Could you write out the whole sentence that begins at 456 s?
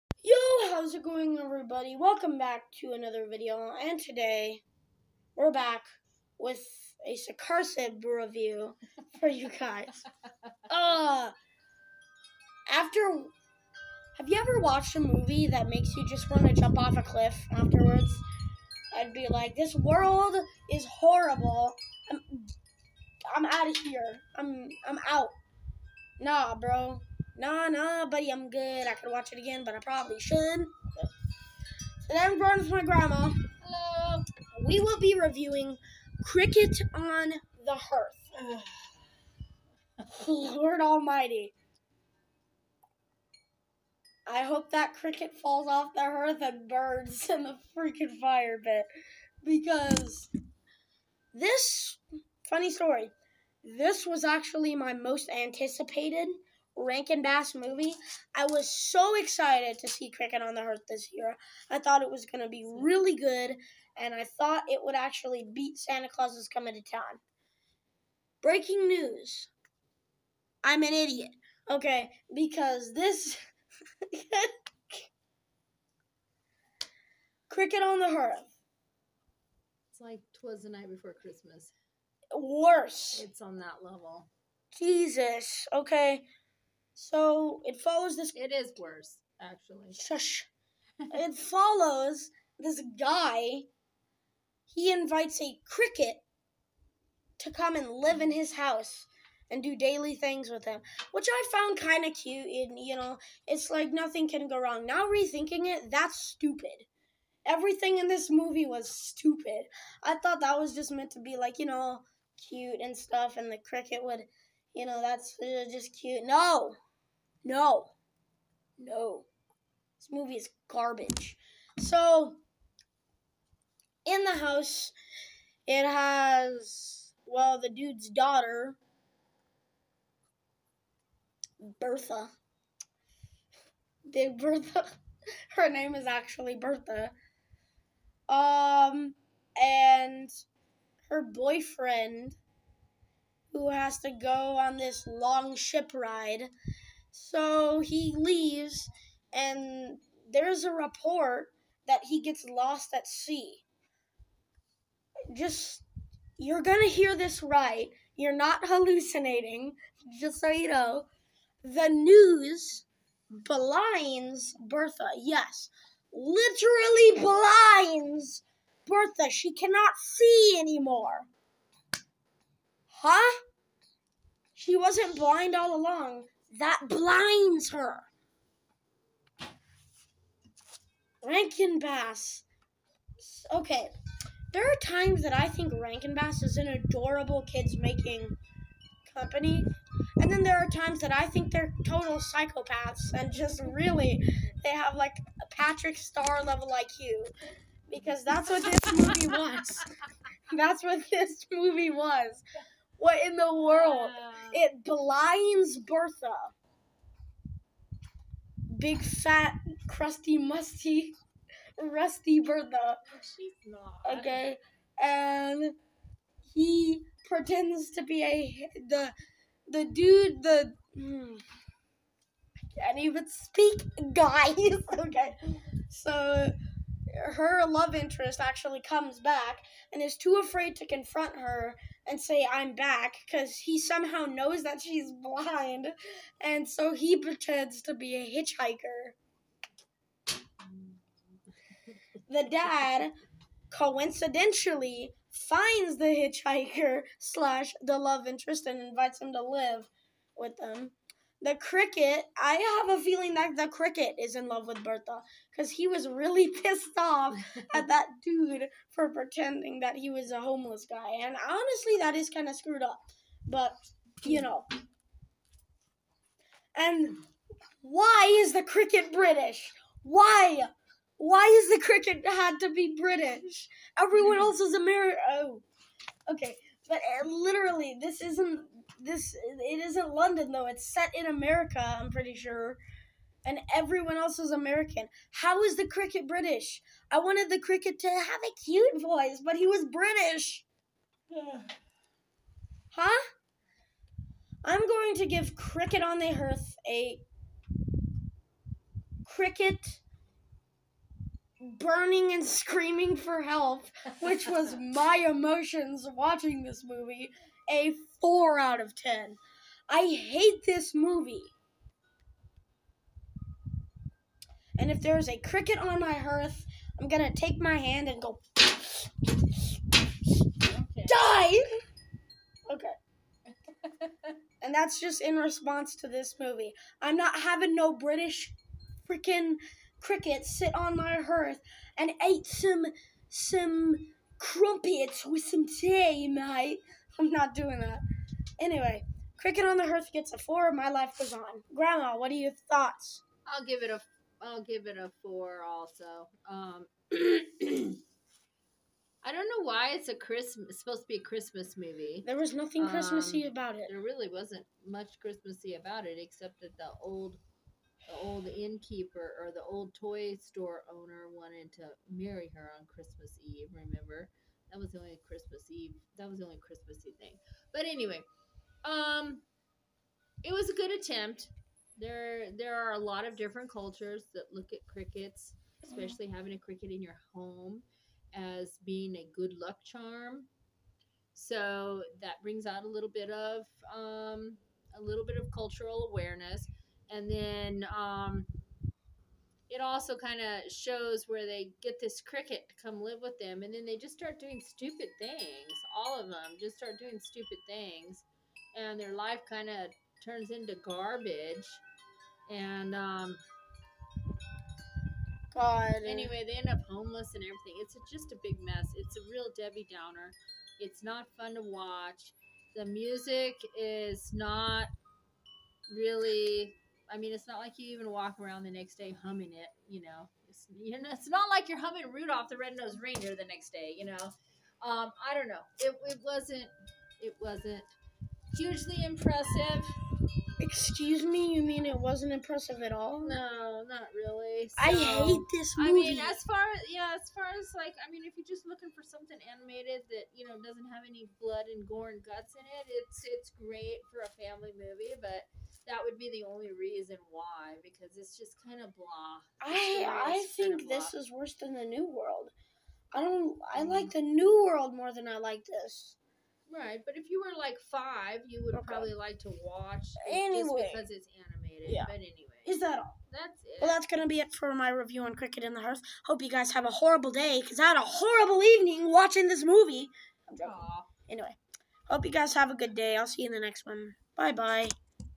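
Right, but if you were like five, you would okay.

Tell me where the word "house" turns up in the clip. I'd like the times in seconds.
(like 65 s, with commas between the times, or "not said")
98 s, 124 s.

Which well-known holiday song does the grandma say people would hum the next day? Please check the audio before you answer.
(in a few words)
Rudolph the Red-Nosed Reindeer.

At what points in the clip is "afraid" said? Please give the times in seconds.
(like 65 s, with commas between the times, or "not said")
230 s.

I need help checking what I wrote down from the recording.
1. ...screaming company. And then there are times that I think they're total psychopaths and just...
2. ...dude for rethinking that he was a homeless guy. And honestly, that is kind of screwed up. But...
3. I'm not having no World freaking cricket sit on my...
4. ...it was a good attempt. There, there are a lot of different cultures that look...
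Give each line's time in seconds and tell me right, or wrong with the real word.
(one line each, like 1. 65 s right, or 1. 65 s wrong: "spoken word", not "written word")
1. 187 s wrong: "making", not "screaming"
2. 258 s wrong: "pretending", not "rethinking"
3. 327 s wrong: "British", not "World"
4. 370 s right.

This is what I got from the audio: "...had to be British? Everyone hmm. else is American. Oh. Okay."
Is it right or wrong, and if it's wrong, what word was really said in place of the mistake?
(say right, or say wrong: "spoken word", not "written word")
right.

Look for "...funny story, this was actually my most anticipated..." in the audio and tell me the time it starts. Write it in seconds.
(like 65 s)
52 s.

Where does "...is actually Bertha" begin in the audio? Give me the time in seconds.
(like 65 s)
135 s.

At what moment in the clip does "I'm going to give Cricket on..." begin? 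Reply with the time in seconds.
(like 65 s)
294 s.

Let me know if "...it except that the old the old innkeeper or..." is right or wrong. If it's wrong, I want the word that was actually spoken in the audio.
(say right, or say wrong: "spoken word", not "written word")
right.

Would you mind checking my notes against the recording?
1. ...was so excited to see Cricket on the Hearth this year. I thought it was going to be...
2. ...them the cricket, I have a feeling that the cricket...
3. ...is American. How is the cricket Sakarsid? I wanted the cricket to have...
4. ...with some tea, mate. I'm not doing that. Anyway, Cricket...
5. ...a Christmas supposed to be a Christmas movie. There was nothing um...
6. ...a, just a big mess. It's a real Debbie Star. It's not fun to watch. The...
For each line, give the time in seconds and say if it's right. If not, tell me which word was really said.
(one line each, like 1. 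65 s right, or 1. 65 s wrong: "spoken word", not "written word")
1. 58 s right
2. 250 s right
3. 284 s wrong: "British", not "Sakarsid"
4. 335 s right
5. 350 s right
6. 407 s wrong: "Downer", not "Star".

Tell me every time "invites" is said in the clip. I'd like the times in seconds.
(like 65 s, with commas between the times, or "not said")
94 s, 248 s.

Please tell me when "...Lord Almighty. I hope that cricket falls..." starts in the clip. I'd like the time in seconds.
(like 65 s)
40 s.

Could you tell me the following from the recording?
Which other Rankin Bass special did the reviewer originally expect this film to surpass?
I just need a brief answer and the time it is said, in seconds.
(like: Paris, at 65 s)
Santa Claus is Coming to Town, at 65 s.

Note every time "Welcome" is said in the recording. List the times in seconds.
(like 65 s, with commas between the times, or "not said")
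1 s.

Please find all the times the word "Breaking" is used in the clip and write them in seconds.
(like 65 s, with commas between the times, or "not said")
68 s.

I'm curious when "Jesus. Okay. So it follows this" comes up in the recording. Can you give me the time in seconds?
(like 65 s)
84 s.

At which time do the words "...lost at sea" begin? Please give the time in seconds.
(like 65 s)
152 s.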